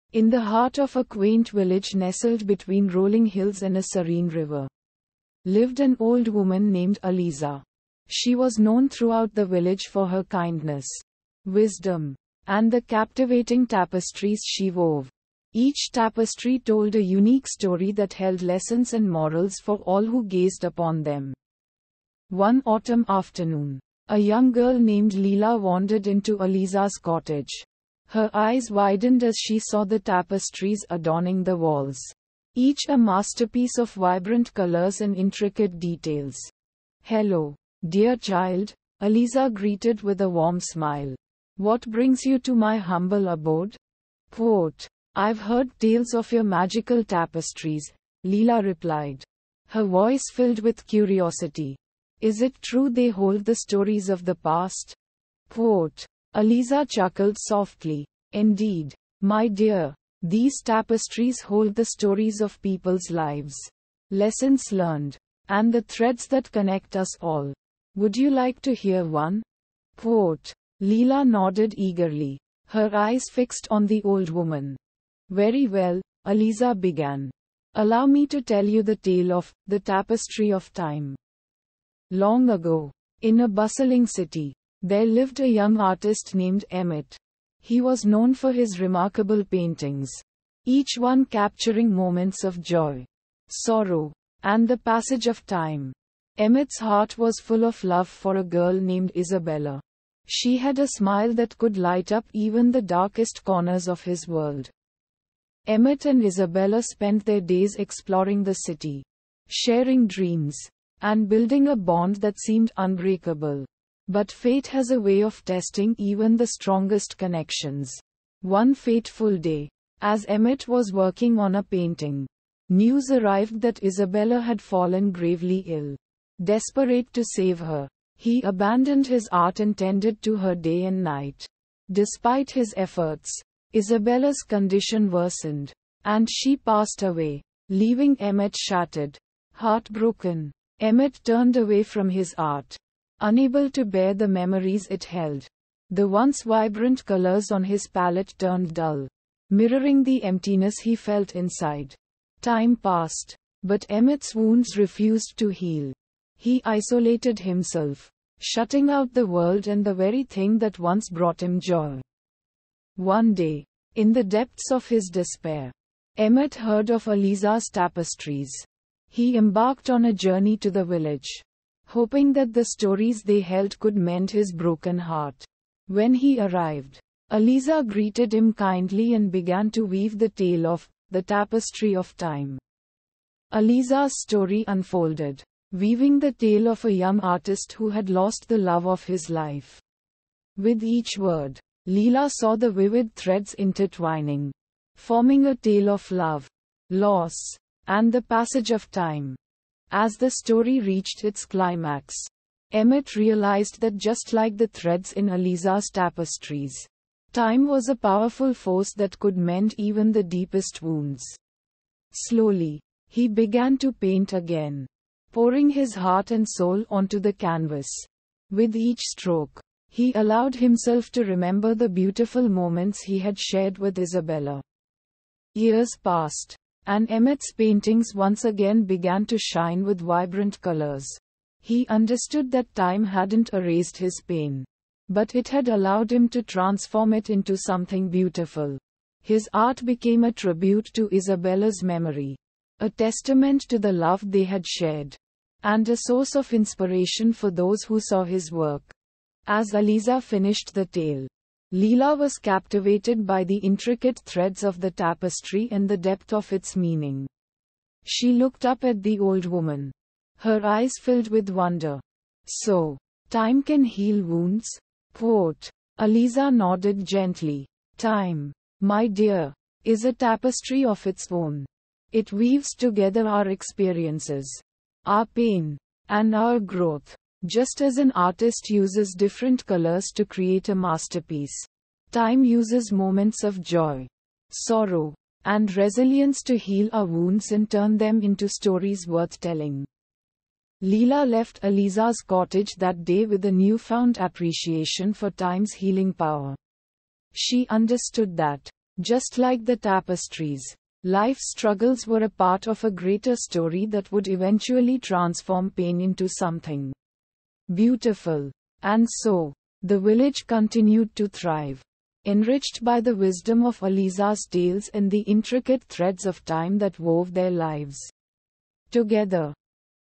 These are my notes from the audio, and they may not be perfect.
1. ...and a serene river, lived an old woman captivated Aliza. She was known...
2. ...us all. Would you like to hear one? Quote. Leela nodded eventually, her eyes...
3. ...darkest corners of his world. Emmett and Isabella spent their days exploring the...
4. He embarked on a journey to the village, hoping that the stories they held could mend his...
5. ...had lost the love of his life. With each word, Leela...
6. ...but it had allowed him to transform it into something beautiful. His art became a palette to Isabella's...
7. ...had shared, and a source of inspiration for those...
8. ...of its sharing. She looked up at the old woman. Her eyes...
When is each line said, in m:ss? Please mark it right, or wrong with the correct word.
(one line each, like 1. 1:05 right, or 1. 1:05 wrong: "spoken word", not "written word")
1. 0:03 wrong: "named", not "captivated"
2. 1:06 wrong: "eagerly", not "eventually"
3. 1:42 right
4. 2:49 right
5. 3:07 right
6. 3:55 wrong: "tribute", not "palette"
7. 4:04 right
8. 4:16 wrong: "meaning", not "sharing".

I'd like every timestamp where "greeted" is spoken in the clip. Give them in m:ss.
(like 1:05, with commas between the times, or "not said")
0:39, 2:57.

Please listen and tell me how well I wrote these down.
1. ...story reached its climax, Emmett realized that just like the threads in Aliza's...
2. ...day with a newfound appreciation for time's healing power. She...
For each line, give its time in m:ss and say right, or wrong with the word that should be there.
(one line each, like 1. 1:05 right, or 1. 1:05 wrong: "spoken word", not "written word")
1. 3:20 right
2. 4:53 right.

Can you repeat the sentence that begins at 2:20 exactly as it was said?
Emmett turned away from his art, unable to bear the memories it held.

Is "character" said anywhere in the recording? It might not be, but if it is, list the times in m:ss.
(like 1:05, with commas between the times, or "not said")
not said.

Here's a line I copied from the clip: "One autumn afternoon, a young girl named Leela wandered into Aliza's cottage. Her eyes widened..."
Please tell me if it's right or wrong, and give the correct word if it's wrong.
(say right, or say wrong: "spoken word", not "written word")
right.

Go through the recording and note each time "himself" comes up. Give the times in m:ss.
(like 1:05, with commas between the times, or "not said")
2:37, 3:40.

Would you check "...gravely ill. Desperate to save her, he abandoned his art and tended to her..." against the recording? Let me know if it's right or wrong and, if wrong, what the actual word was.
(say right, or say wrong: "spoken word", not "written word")
right.